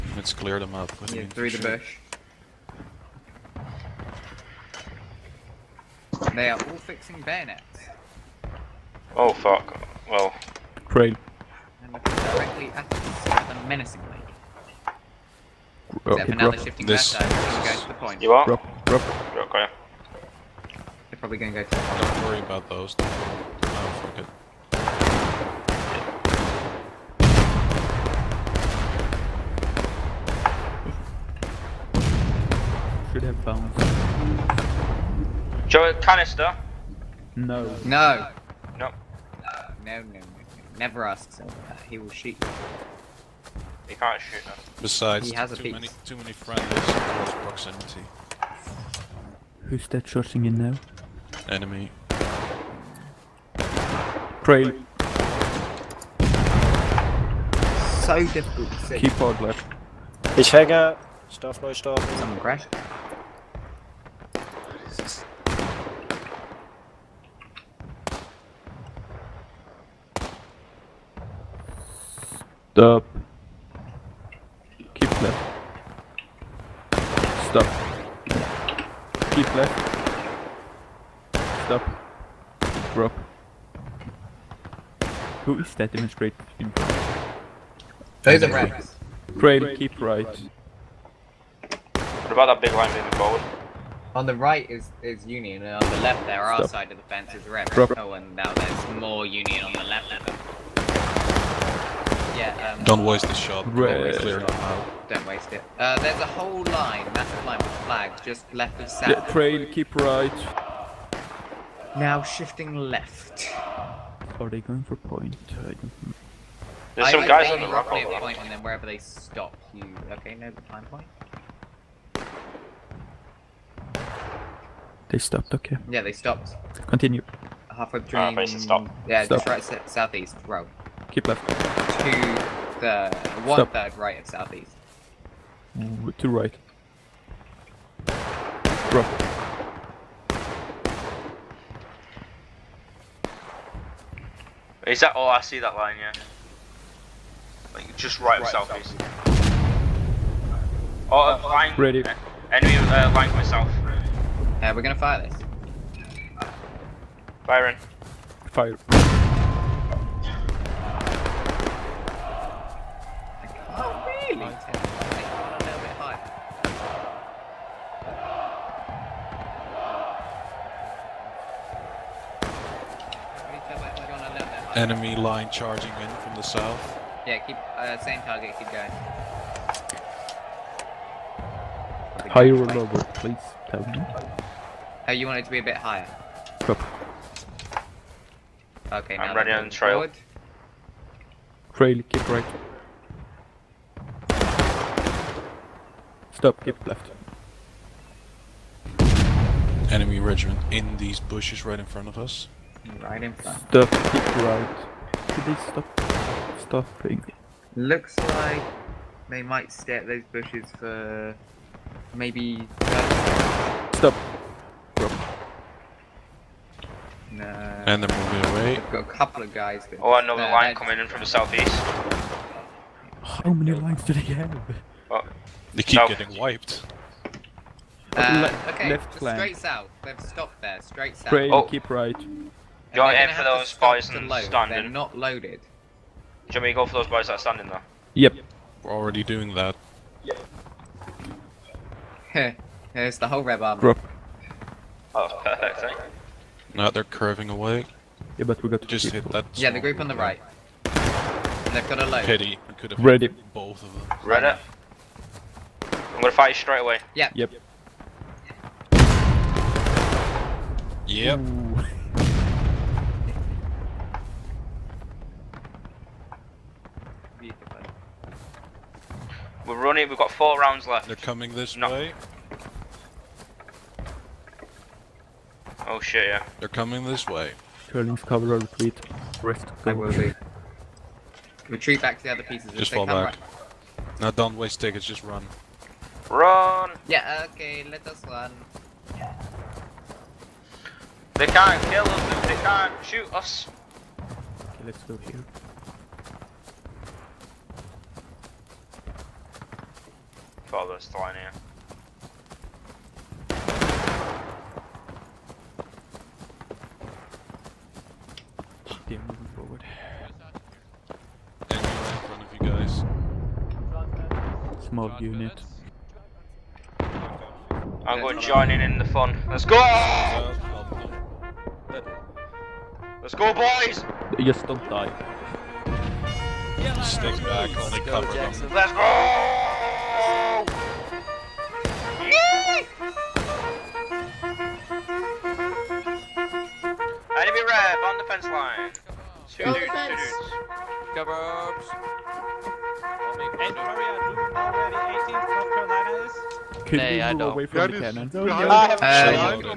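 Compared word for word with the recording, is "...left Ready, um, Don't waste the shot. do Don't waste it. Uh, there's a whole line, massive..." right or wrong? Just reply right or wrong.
wrong.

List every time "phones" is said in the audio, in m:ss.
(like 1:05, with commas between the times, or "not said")
0:33.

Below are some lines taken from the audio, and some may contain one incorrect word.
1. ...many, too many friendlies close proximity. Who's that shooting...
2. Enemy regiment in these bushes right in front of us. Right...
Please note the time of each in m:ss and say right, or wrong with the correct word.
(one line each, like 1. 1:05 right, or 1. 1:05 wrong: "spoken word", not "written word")
1. 0:45 right
2. 3:19 right.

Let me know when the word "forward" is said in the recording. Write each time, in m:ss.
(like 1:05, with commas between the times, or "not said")
1:33, 3:09, 5:09.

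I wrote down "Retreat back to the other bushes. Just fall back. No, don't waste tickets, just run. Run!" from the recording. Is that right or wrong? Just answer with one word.
wrong.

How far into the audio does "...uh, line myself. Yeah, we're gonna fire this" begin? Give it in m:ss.
2:32.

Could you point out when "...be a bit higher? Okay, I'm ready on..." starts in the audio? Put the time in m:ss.
3:05.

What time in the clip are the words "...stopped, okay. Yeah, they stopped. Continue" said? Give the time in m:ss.
2:05.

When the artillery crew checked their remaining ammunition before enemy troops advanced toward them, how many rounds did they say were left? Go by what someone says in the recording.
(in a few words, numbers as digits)
4.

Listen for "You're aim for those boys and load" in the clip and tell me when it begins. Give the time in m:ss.
3:52.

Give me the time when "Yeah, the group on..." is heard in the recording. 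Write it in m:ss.
4:09.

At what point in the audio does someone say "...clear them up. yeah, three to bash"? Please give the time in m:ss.
0:00.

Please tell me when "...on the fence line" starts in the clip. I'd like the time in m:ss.
5:38.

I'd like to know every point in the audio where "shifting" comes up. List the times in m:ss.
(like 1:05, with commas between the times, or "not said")
0:16, 1:52.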